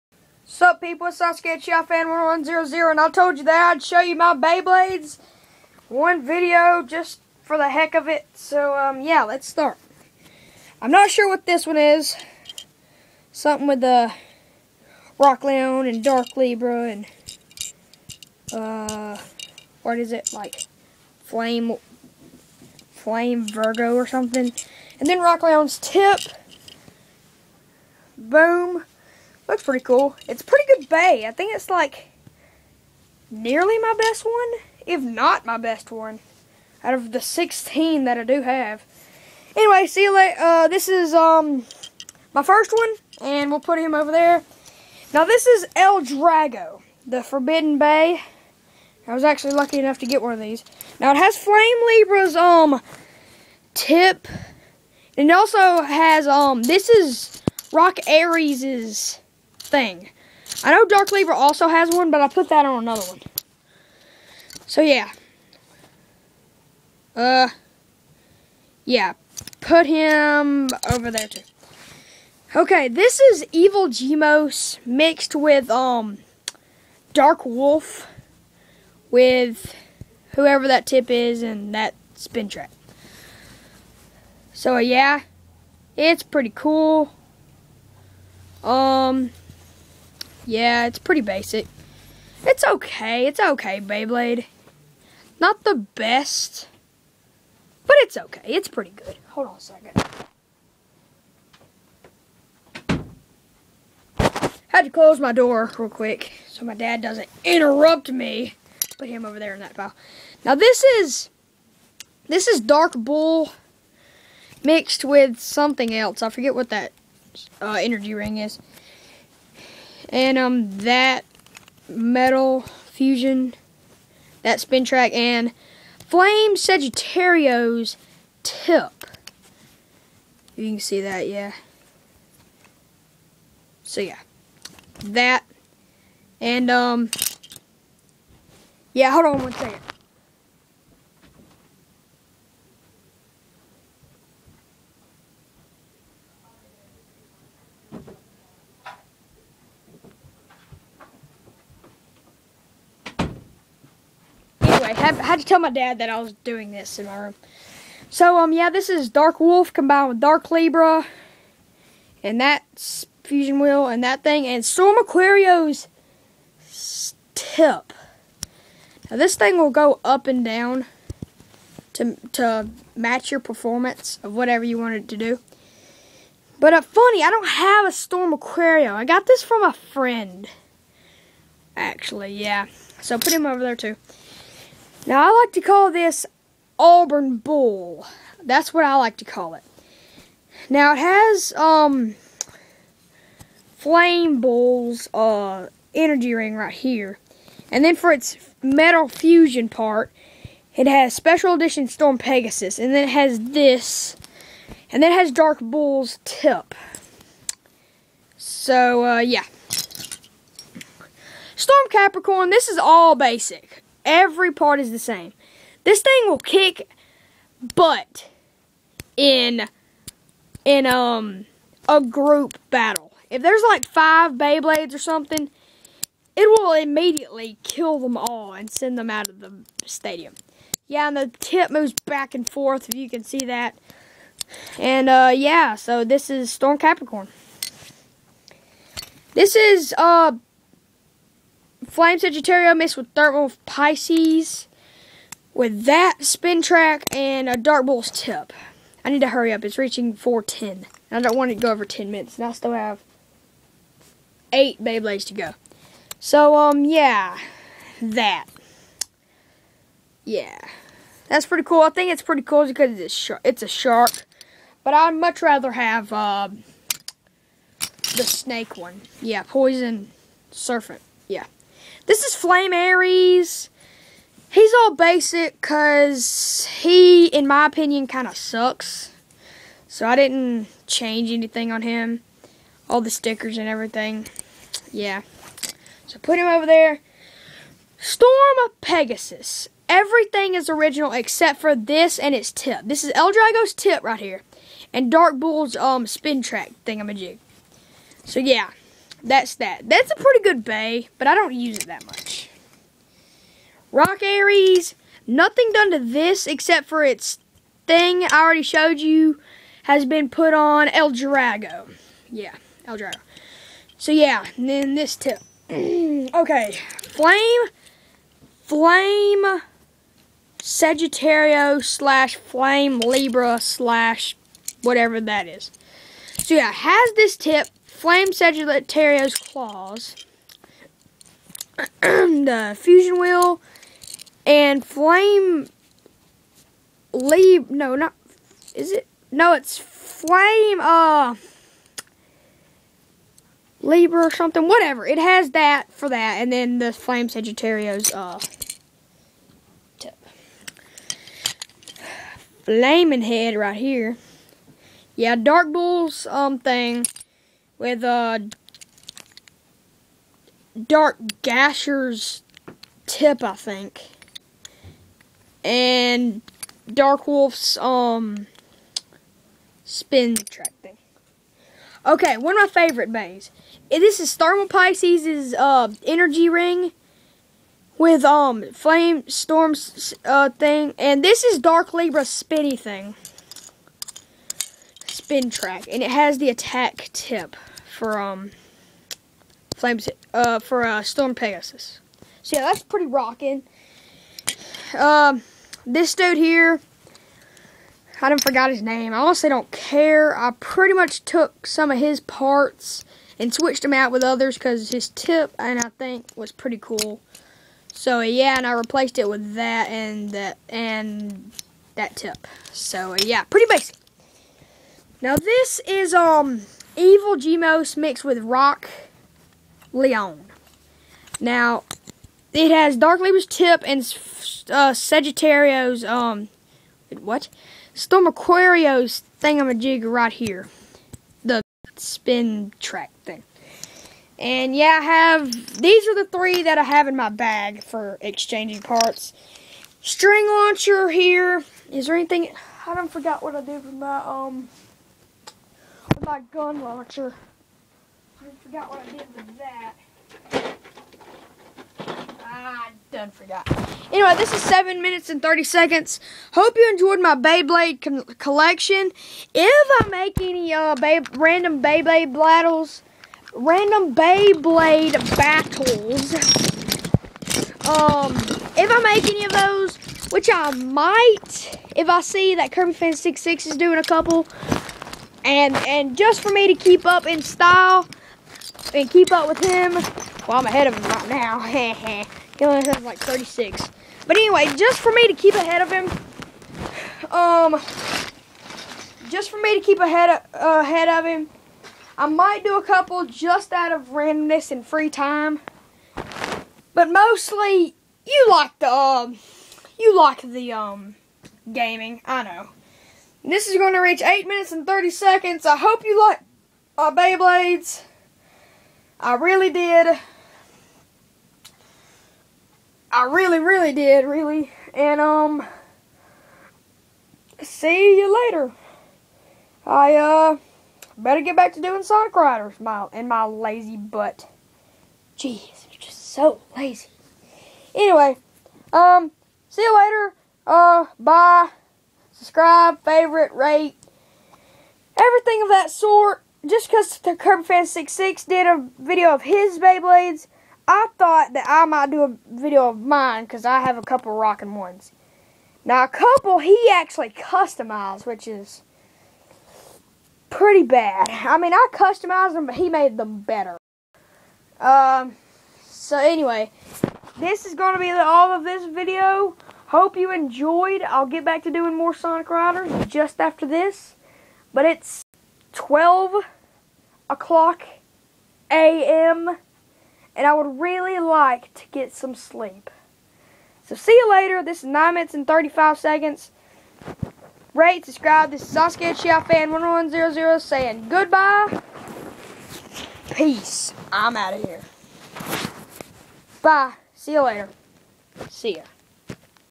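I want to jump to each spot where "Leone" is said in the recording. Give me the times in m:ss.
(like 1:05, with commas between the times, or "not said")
0:15, 0:25, 6:59.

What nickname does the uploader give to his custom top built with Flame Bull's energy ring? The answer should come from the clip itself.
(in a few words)
Auburn Bull.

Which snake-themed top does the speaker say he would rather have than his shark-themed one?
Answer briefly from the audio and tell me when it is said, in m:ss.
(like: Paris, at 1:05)
Poison Serpent, at 4:29.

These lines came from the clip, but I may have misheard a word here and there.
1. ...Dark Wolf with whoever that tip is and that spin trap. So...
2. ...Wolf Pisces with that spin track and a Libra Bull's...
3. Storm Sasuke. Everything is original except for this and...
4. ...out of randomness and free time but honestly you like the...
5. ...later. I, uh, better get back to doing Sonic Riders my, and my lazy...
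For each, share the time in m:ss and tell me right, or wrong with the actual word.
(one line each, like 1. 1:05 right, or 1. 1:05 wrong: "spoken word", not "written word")
1. 1:17 right
2. 4:03 wrong: "Dark", not "Libra"
3. 4:47 wrong: "Pegasus", not "Sasuke"
4. 8:13 wrong: "mostly", not "honestly"
5. 8:38 right.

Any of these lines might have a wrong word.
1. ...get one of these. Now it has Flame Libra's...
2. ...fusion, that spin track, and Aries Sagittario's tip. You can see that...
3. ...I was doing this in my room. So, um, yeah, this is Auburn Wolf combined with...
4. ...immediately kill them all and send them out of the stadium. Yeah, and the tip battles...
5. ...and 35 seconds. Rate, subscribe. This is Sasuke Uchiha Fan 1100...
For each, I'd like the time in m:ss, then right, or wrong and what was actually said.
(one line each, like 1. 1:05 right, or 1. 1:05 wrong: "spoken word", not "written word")
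1. 0:50 right
2. 2:02 wrong: "Flame", not "Aries"
3. 2:36 wrong: "Dark", not "Auburn"
4. 3:46 wrong: "moves", not "battles"
5. 9:35 right.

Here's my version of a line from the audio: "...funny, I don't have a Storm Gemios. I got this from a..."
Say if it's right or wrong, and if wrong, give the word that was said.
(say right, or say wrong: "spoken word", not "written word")
wrong: "Aquario", not "Gemios".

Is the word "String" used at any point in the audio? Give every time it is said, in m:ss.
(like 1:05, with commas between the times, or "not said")
7:20.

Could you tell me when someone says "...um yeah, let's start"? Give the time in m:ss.
0:08.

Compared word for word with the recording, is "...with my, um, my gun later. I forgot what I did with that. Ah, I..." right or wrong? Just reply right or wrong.
wrong.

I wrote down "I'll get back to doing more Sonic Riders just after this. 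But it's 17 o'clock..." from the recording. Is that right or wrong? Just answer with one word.
wrong.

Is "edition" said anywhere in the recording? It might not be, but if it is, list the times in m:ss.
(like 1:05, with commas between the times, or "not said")
3:21.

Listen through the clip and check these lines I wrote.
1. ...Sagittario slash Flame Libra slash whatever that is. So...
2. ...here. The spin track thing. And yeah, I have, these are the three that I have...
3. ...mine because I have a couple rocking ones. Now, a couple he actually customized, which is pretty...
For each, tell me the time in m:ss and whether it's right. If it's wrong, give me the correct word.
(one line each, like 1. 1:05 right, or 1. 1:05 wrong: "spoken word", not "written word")
1. 5:20 right
2. 7:10 right
3. 9:02 right.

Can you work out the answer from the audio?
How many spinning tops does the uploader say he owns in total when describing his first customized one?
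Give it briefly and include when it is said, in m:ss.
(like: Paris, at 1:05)
16, at 0:37.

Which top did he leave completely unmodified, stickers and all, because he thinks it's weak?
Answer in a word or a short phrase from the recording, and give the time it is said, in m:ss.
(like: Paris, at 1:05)
Flame Aries, at 4:32.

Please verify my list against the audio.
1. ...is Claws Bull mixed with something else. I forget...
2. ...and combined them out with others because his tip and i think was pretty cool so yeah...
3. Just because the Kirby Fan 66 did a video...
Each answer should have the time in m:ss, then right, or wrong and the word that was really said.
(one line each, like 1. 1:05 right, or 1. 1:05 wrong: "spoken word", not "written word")
1. 1:52 wrong: "Dark", not "Claws"
2. 6:43 wrong: "switched", not "combined"
3. 8:56 right.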